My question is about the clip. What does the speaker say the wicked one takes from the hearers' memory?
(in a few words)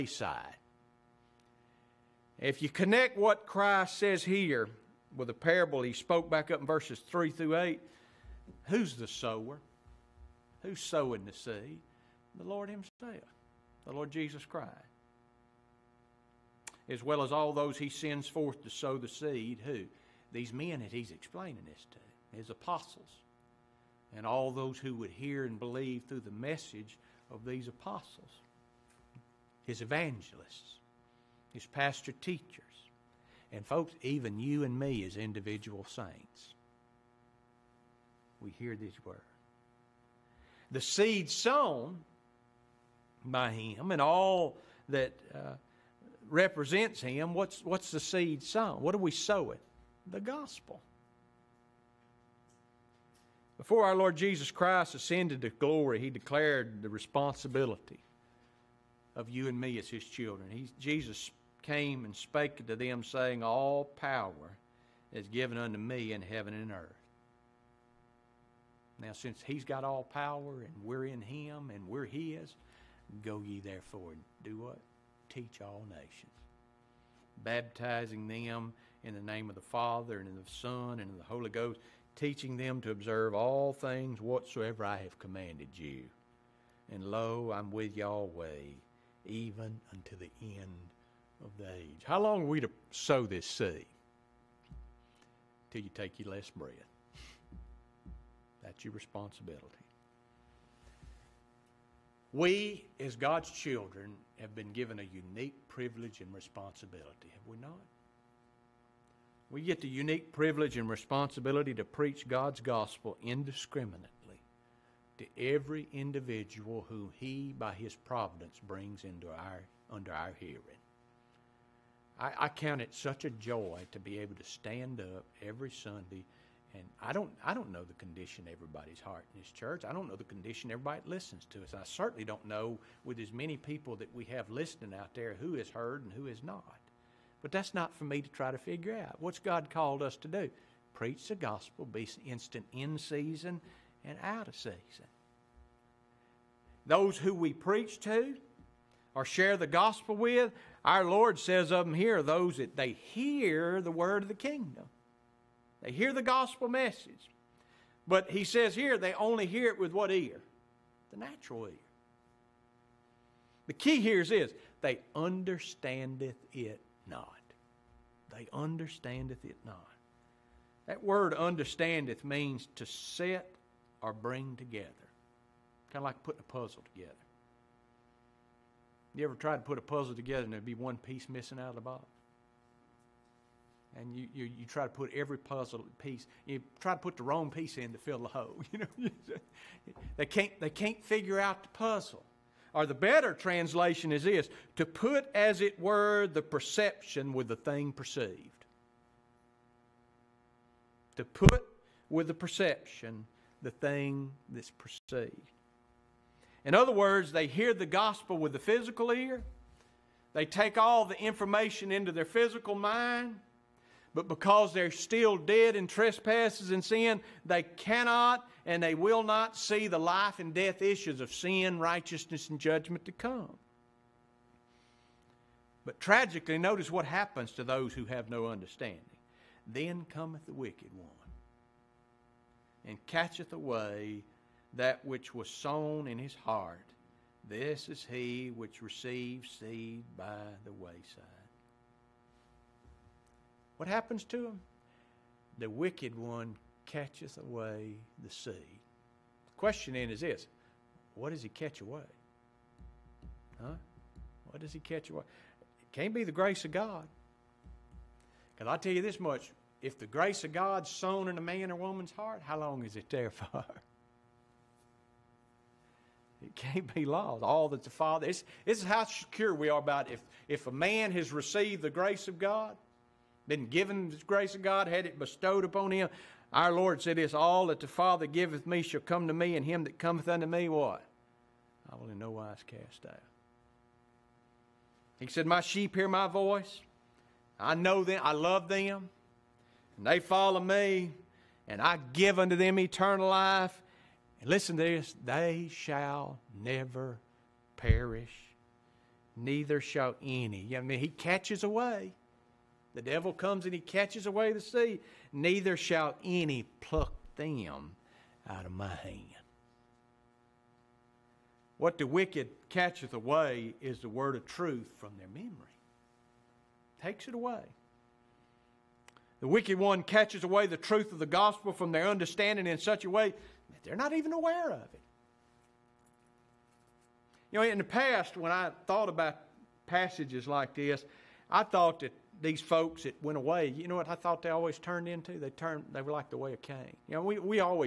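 the word of truth.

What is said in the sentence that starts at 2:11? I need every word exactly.
I certainly don't know with as many people that we have listening out there who has heard and who has not.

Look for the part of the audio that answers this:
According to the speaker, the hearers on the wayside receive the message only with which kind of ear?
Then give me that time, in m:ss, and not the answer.
2:41.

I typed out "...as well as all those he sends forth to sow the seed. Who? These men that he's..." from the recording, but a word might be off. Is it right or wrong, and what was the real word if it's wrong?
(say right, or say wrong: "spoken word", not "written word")
right.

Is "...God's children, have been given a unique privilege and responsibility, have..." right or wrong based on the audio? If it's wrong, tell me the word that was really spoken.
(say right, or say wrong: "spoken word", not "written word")
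right.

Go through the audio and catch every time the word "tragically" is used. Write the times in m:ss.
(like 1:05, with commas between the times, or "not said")
3:45.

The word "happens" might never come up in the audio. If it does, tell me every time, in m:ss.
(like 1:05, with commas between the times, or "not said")
3:47, 4:03.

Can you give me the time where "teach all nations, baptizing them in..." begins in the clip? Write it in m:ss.
1:15.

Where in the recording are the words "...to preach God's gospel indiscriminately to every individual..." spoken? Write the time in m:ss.
1:51.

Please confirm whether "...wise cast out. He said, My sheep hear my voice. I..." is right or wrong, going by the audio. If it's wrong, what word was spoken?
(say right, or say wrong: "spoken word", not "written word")
right.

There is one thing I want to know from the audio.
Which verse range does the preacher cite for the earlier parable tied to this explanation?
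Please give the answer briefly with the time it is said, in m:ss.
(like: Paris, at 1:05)
verses 3 through 8, at 0:06.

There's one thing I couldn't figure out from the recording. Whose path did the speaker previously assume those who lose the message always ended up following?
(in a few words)
Cain.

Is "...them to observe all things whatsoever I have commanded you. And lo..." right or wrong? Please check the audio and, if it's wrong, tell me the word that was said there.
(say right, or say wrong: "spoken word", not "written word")
right.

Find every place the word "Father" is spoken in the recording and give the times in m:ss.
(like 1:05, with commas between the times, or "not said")
1:19, 4:27, 4:37.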